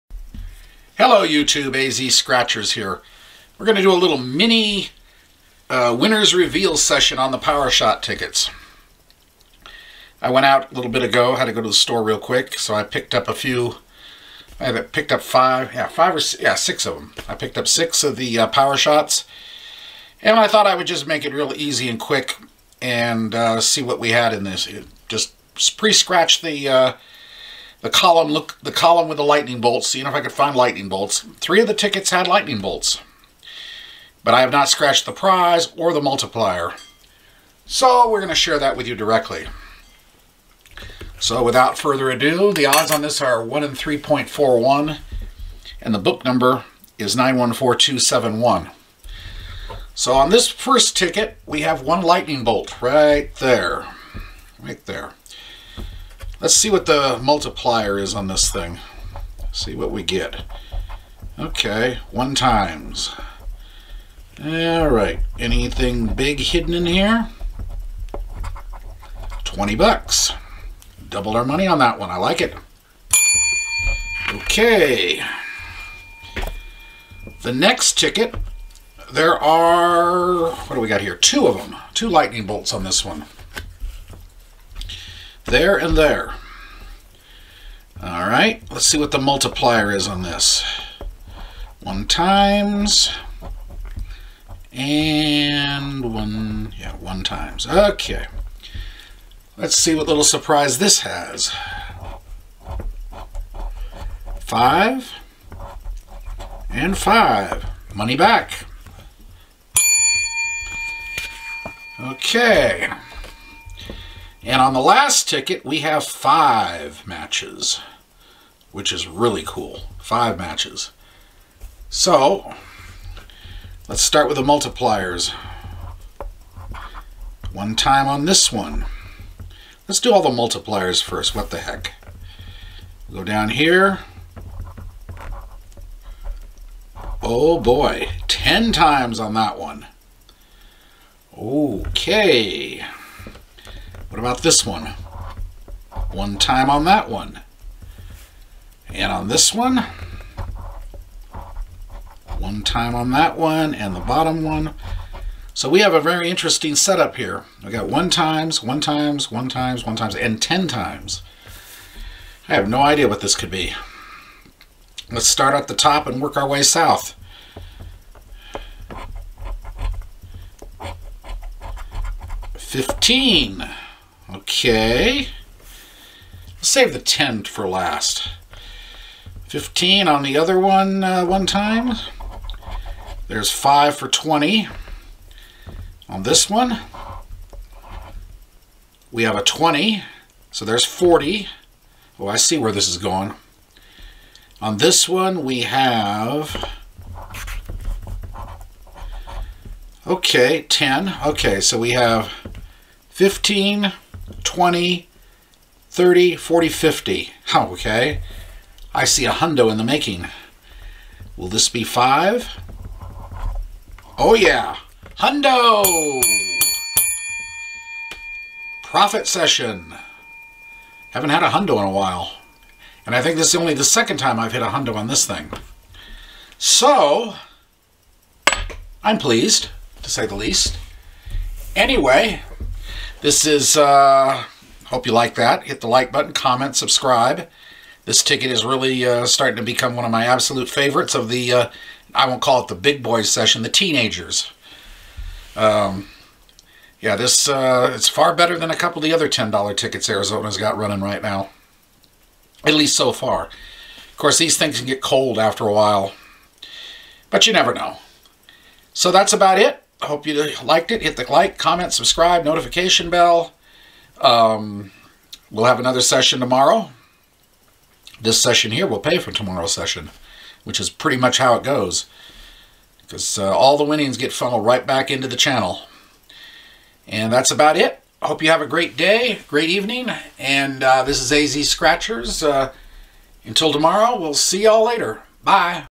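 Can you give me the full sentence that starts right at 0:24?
It just pre-scratch the uh, the column look the column with the lightning bolts, seeing if I could find lightning bolts.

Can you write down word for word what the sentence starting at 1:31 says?
1 times and 1, yeah, 1 times.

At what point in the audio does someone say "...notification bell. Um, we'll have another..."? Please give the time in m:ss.
4:22.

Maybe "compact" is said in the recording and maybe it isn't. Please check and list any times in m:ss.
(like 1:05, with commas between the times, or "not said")
not said.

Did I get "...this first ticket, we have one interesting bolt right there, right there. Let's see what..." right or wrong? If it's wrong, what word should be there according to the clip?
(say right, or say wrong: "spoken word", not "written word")
wrong: "lightning", not "interesting".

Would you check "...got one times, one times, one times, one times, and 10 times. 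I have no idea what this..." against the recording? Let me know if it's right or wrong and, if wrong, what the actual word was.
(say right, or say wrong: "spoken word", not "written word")
right.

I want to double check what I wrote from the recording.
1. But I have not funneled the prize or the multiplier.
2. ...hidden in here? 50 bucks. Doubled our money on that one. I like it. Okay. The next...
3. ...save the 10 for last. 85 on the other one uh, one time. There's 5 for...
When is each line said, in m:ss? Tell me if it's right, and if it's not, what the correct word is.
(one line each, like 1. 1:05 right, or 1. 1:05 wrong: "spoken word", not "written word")
1. 0:34 wrong: "scratched", not "funneled"
2. 1:06 wrong: "20", not "50"
3. 2:56 wrong: "15", not "85".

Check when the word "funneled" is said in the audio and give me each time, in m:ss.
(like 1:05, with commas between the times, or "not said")
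4:34.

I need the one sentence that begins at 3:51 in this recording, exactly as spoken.
Anyway, this is, uh, hope you like that.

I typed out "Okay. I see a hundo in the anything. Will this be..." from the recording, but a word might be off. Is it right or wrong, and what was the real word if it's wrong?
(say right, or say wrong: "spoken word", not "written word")
wrong: "making", not "anything".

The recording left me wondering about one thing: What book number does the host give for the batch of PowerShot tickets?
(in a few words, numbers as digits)
914271.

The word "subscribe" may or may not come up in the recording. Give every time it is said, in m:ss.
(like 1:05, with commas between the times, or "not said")
3:56, 4:21.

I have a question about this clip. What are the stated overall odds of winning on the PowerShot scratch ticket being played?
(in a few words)
1 in 3.41.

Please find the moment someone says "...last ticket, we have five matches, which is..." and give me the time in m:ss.
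1:54.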